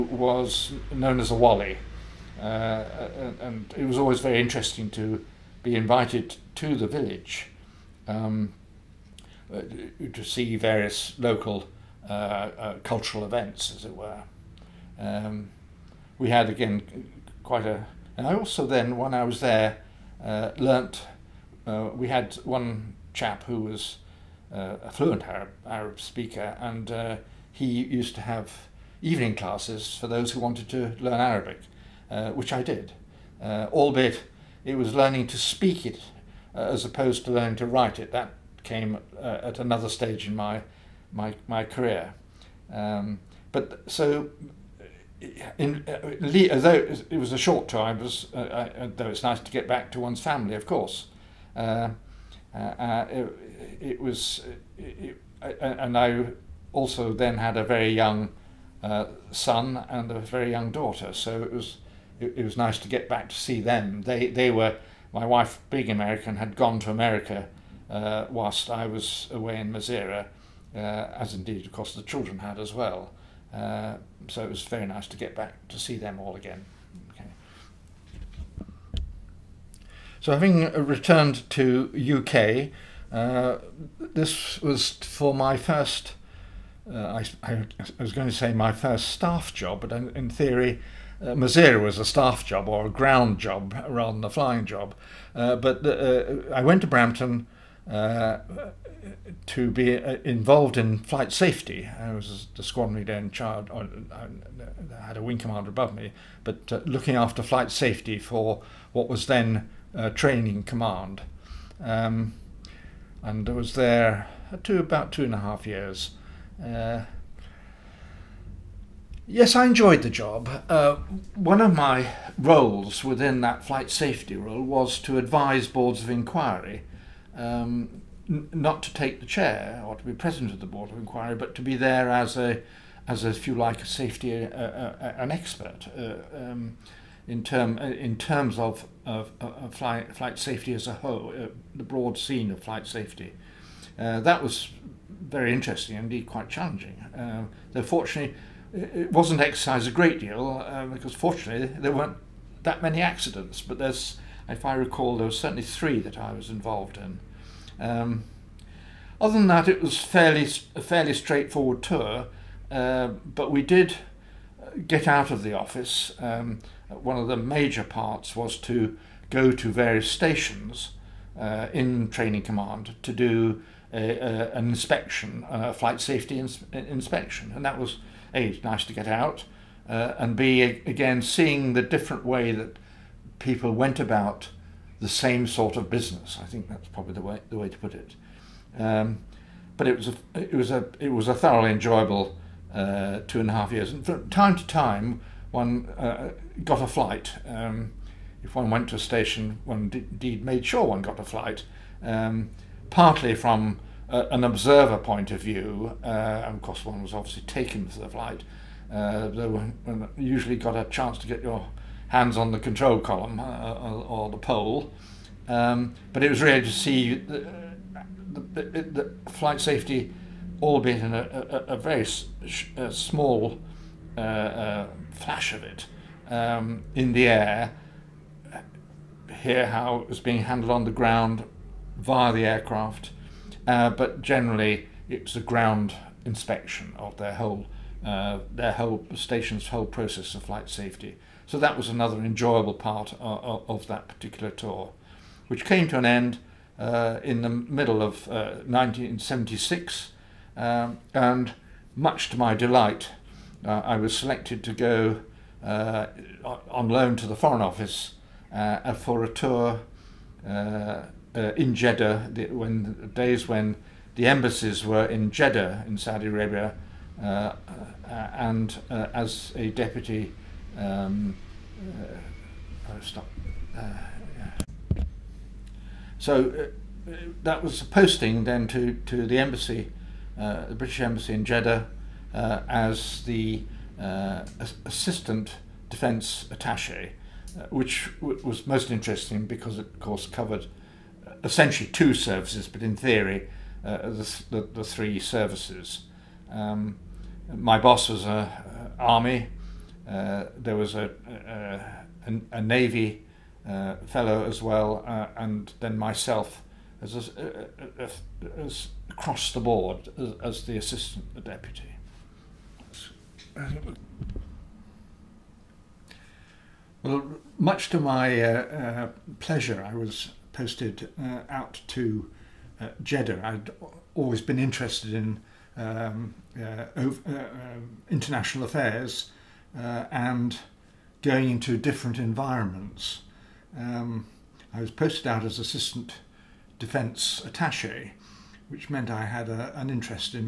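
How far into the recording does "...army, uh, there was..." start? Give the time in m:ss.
4:58.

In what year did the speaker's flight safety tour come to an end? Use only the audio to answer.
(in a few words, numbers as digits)
1976.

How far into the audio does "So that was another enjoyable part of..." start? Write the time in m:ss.
4:01.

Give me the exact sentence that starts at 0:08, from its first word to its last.
Um, uh, to see various local uh, uh, cultural events, as it were.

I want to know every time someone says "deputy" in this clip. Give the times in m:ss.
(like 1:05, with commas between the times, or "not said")
4:29, 5:11.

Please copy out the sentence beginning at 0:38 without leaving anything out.
That came uh, at another stage in my my my career.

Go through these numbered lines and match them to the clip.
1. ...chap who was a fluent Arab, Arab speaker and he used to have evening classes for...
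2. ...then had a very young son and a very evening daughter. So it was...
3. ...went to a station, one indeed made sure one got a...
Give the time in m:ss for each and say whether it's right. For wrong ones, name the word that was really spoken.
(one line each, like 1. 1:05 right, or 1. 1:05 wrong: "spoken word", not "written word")
1. 0:23 right
2. 0:57 wrong: "young", not "evening"
3. 3:18 right.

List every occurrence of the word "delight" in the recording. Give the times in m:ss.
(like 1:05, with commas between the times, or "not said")
4:12.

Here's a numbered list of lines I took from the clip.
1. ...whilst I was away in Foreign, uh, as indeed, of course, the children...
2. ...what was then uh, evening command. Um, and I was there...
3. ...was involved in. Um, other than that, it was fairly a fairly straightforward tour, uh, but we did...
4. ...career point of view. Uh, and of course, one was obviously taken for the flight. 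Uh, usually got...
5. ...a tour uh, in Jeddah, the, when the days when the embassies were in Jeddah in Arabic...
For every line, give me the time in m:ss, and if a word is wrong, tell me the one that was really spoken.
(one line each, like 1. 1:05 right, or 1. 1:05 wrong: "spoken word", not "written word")
1. 1:08 wrong: "Masirah", not "Foreign"
2. 1:48 wrong: "training", not "evening"
3. 2:36 right
4. 3:24 wrong: "observer", not "career"
5. 4:19 wrong: "Saudi", not "Arabic".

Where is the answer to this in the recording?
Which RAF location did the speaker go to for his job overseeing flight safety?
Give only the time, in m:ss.
1:36.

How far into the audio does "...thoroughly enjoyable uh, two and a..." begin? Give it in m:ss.
3:11.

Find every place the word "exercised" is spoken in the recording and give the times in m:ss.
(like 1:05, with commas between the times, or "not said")
2:29.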